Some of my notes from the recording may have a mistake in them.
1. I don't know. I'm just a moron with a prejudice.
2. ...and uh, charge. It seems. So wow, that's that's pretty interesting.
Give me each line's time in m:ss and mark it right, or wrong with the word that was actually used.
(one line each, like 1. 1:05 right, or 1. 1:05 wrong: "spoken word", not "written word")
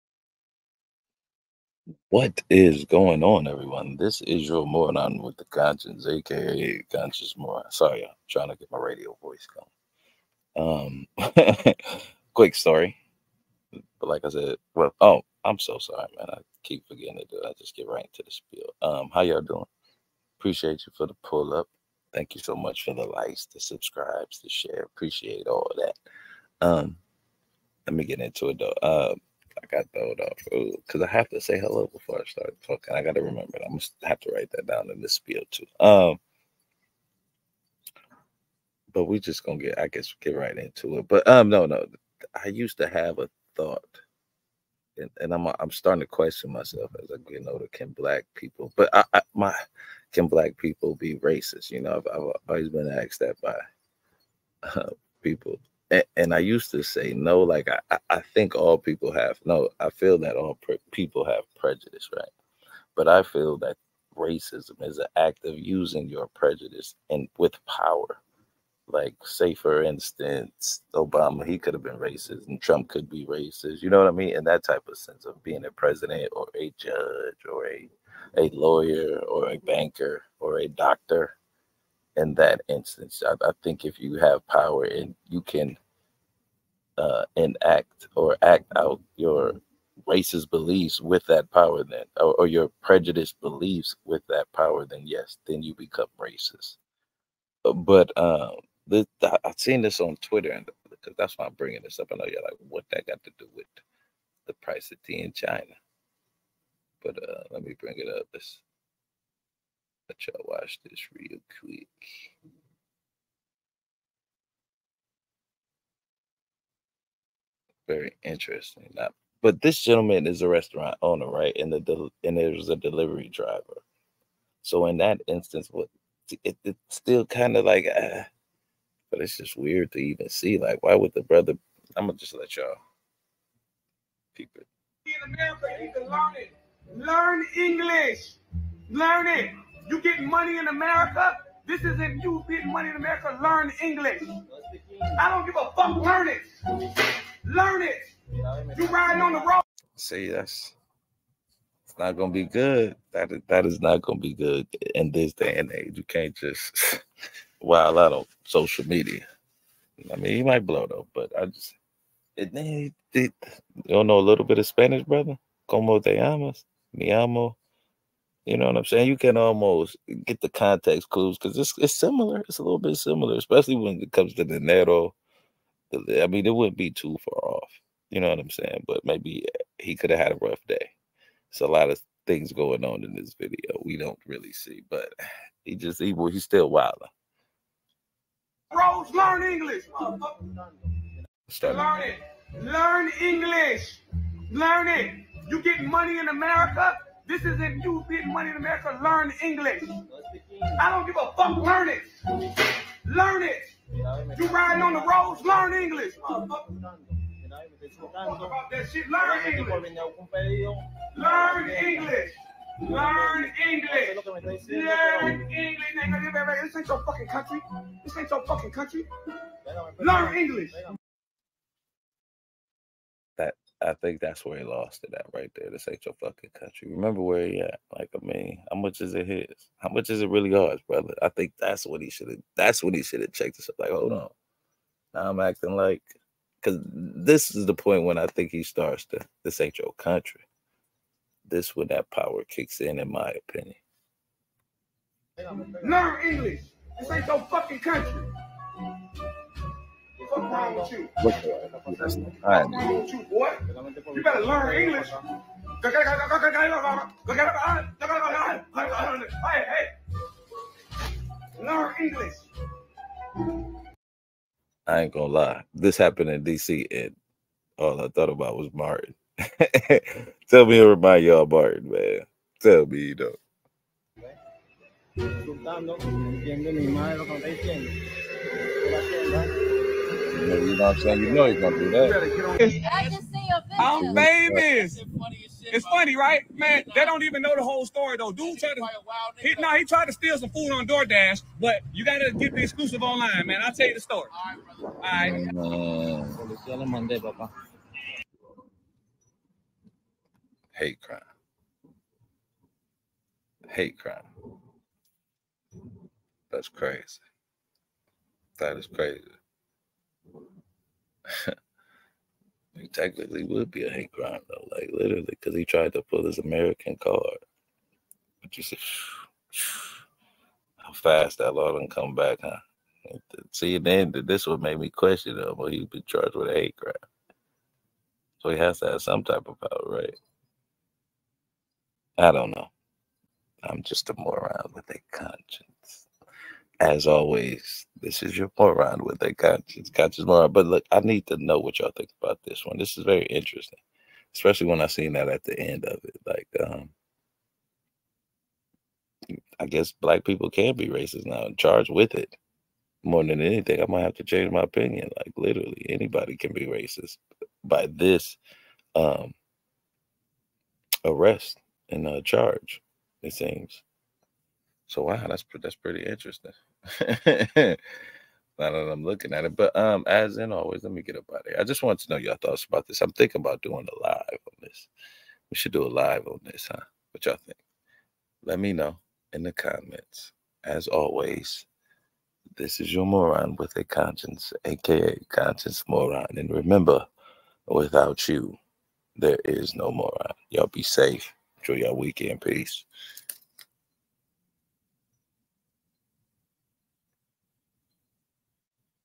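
1. 5:32 wrong: "conscience", not "prejudice"
2. 6:01 right.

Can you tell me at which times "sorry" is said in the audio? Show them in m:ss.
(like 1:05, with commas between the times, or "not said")
0:07, 0:15.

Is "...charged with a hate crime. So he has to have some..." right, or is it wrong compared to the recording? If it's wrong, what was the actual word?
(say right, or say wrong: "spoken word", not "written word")
right.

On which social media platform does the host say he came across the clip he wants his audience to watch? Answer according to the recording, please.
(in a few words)
Twitter.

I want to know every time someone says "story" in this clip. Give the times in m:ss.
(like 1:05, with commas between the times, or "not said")
0:12, 4:47, 4:53.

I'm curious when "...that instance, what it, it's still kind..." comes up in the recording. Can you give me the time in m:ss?
2:04.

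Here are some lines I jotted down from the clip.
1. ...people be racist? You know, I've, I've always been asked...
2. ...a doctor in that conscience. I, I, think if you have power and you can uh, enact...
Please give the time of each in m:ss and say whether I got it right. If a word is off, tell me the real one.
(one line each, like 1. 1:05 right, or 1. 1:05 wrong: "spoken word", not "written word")
1. 0:50 right
2. 1:20 wrong: "instance", not "conscience".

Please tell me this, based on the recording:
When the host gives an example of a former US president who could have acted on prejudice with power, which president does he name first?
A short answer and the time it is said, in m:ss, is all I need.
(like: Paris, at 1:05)
Obama, at 1:10.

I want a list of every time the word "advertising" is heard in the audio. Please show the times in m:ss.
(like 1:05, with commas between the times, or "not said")
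not said.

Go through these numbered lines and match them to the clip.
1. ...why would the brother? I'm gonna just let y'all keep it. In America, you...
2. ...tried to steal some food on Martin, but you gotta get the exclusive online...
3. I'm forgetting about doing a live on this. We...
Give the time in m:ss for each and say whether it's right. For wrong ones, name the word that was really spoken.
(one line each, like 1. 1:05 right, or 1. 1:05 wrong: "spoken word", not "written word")
1. 2:10 right
2. 4:49 wrong: "DoorDash", not "Martin"
3. 6:13 wrong: "thinking", not "forgetting".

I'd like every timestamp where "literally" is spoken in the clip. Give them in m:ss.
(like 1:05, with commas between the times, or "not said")
5:14, 5:55.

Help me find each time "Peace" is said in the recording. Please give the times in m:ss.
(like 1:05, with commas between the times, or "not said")
6:32.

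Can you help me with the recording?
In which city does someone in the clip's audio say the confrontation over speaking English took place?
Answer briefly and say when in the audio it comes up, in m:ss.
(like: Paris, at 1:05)
DC, at 4:26.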